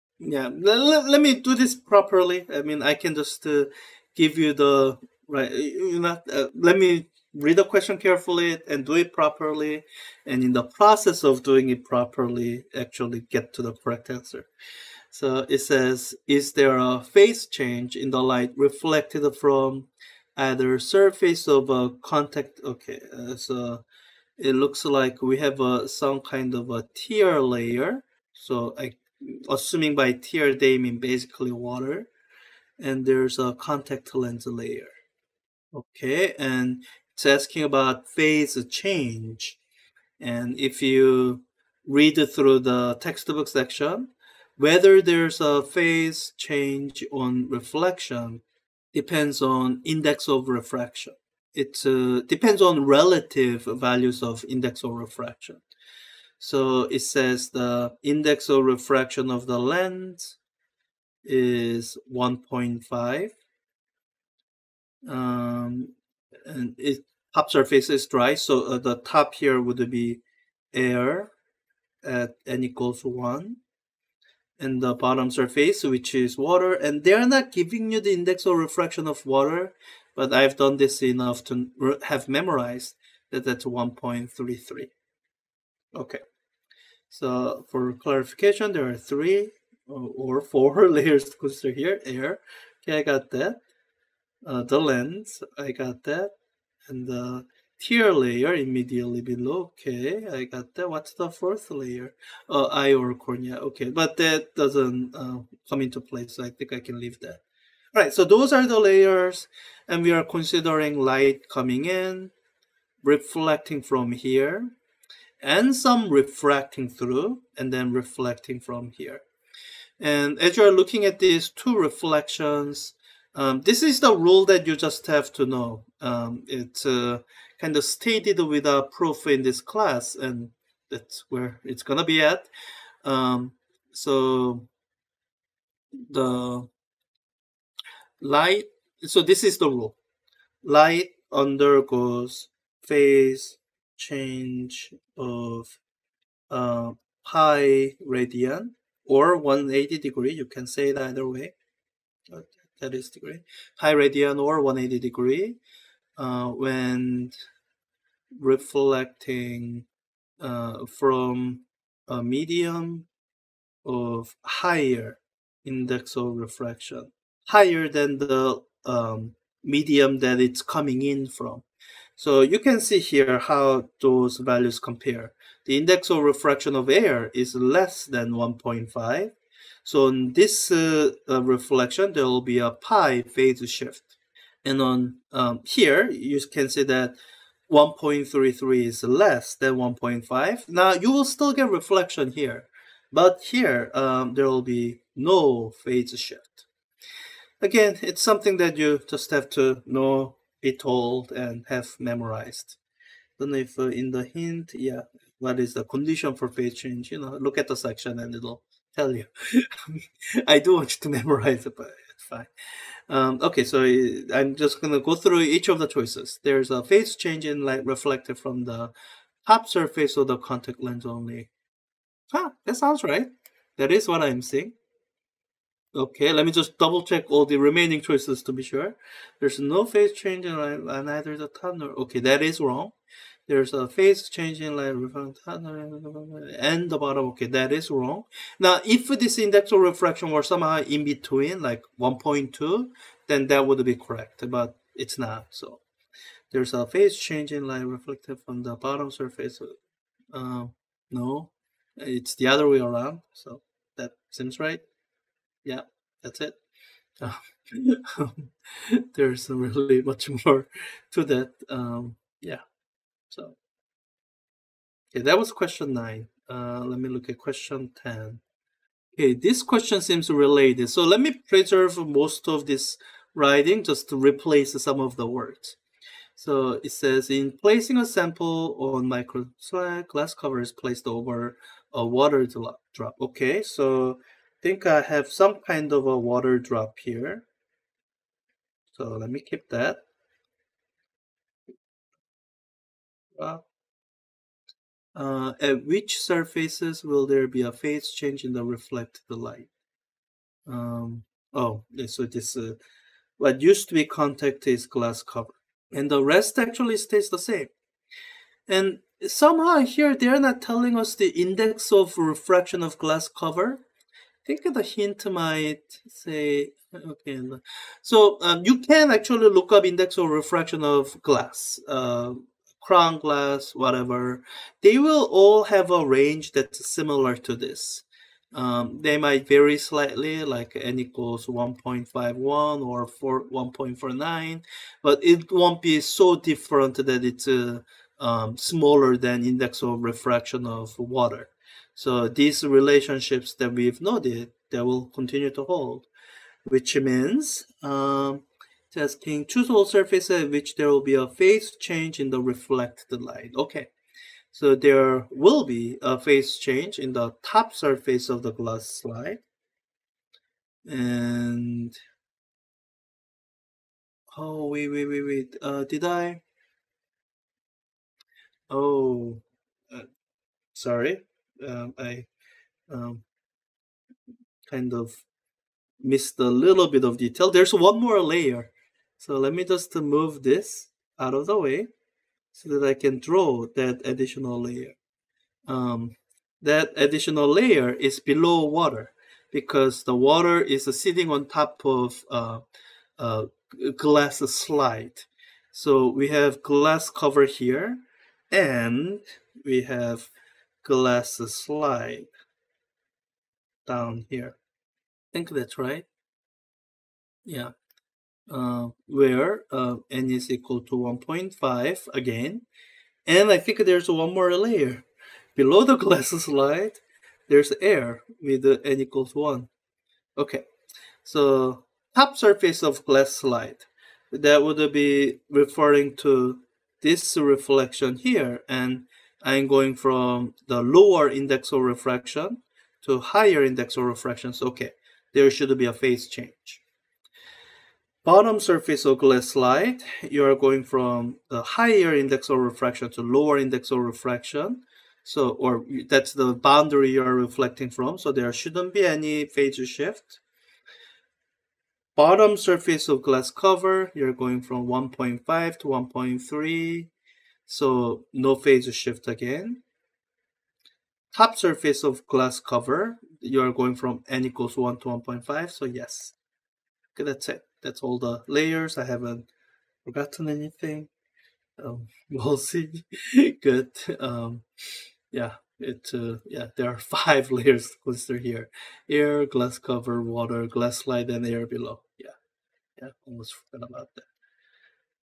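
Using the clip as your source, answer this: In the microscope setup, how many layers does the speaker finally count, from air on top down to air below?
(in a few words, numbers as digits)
5.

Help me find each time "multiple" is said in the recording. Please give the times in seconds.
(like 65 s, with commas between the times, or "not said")
not said.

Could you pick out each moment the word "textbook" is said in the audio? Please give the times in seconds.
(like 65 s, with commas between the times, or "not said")
42 s.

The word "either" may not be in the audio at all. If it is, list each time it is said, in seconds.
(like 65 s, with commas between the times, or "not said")
20 s, 150 s, 231 s.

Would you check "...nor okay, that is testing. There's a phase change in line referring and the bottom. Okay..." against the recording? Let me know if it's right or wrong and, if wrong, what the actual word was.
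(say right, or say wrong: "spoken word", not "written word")
wrong: "wrong", not "testing".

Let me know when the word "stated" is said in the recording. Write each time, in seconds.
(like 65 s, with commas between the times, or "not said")
127 s.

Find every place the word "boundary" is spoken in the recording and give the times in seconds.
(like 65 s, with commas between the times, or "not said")
446 s.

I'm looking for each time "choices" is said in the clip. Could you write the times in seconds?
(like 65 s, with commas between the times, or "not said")
215 s, 227 s.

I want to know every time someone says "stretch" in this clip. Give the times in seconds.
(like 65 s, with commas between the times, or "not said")
not said.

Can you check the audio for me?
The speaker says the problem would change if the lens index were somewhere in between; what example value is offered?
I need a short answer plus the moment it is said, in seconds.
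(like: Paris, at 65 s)
1.2, at 241 s.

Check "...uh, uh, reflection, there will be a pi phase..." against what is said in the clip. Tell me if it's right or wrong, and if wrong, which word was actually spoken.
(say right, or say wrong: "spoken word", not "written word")
right.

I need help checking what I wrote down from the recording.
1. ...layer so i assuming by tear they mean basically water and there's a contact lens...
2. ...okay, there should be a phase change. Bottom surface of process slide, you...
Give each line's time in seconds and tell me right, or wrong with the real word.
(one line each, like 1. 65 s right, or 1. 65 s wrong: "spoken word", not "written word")
1. 27 s right
2. 434 s wrong: "glass", not "process".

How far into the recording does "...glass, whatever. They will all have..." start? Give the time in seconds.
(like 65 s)
323 s.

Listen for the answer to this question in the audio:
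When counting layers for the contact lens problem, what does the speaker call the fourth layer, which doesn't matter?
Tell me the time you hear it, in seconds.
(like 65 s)
102 s.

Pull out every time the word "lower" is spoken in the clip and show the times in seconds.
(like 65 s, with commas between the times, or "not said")
430 s, 443 s.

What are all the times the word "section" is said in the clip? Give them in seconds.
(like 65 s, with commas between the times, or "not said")
43 s, 207 s.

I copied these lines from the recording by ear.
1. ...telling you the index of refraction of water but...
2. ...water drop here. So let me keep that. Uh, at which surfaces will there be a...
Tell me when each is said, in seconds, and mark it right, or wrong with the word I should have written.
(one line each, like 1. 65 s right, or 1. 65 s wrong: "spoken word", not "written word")
1. 77 s wrong: "giving", not "telling"
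2. 286 s right.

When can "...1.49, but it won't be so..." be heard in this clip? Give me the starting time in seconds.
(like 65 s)
333 s.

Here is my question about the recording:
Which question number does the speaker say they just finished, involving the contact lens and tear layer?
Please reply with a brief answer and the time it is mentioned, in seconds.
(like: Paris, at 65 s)
9, at 265 s.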